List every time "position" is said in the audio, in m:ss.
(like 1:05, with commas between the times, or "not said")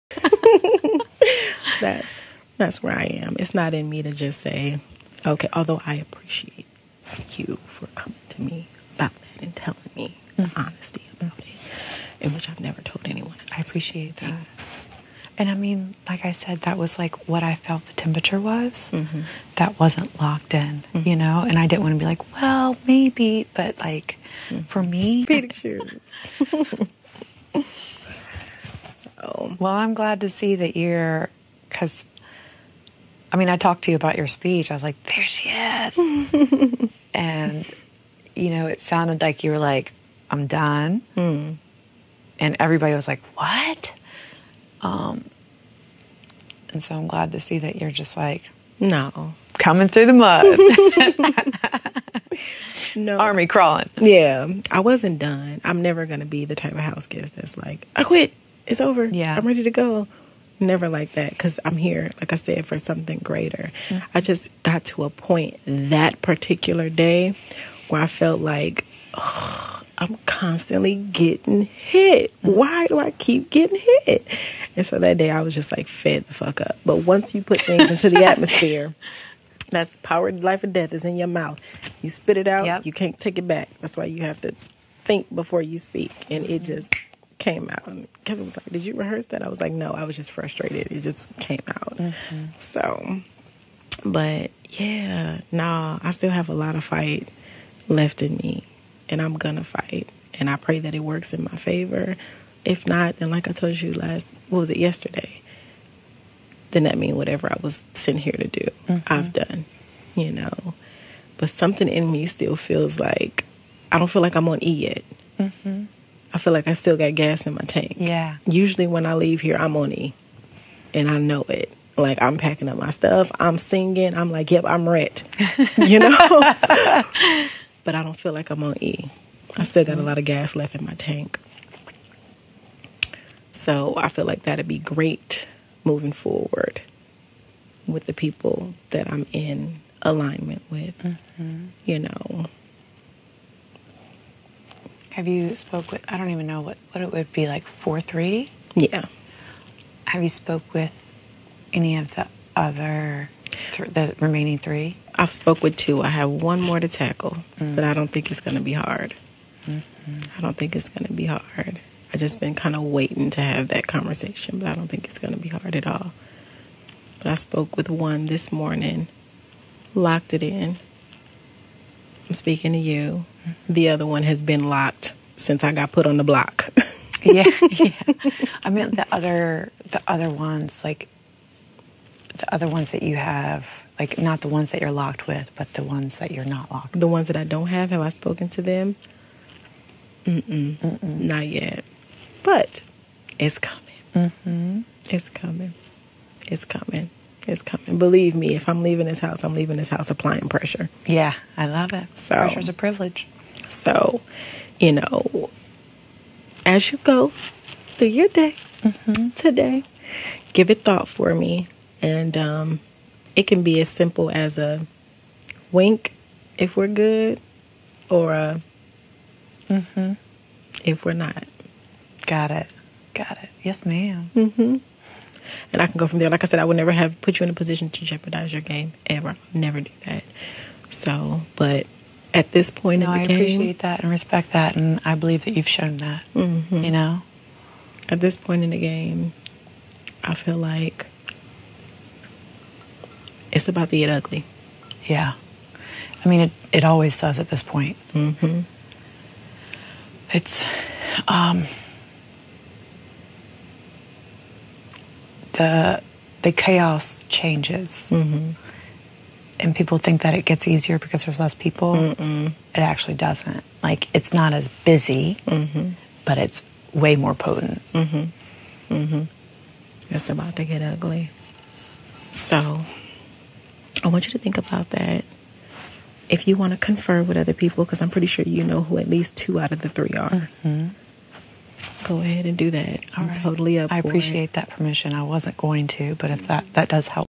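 3:47.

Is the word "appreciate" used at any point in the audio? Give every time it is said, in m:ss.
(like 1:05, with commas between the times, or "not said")
0:05, 0:13, 3:53, 4:43.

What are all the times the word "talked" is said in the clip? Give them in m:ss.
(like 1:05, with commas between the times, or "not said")
0:33.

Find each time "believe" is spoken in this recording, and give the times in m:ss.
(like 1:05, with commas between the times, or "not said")
3:17, 3:55.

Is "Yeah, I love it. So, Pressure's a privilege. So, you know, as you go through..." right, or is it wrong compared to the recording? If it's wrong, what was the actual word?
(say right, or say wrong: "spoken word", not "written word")
right.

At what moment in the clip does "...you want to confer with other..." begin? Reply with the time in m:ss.
4:36.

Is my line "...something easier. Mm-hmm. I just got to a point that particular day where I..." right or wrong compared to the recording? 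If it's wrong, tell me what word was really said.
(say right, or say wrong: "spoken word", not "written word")
wrong: "greater", not "easier".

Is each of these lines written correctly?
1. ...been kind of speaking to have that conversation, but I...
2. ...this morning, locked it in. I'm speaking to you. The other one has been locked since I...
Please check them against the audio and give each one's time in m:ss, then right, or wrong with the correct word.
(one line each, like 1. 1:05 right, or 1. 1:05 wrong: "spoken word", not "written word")
1. 2:42 wrong: "waiting", not "speaking"
2. 2:48 right.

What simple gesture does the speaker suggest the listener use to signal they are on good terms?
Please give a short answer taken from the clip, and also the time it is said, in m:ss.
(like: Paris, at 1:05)
A wink, at 3:34.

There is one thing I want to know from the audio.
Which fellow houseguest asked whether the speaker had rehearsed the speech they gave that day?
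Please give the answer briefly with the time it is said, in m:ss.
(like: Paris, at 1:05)
Kevin, at 1:28.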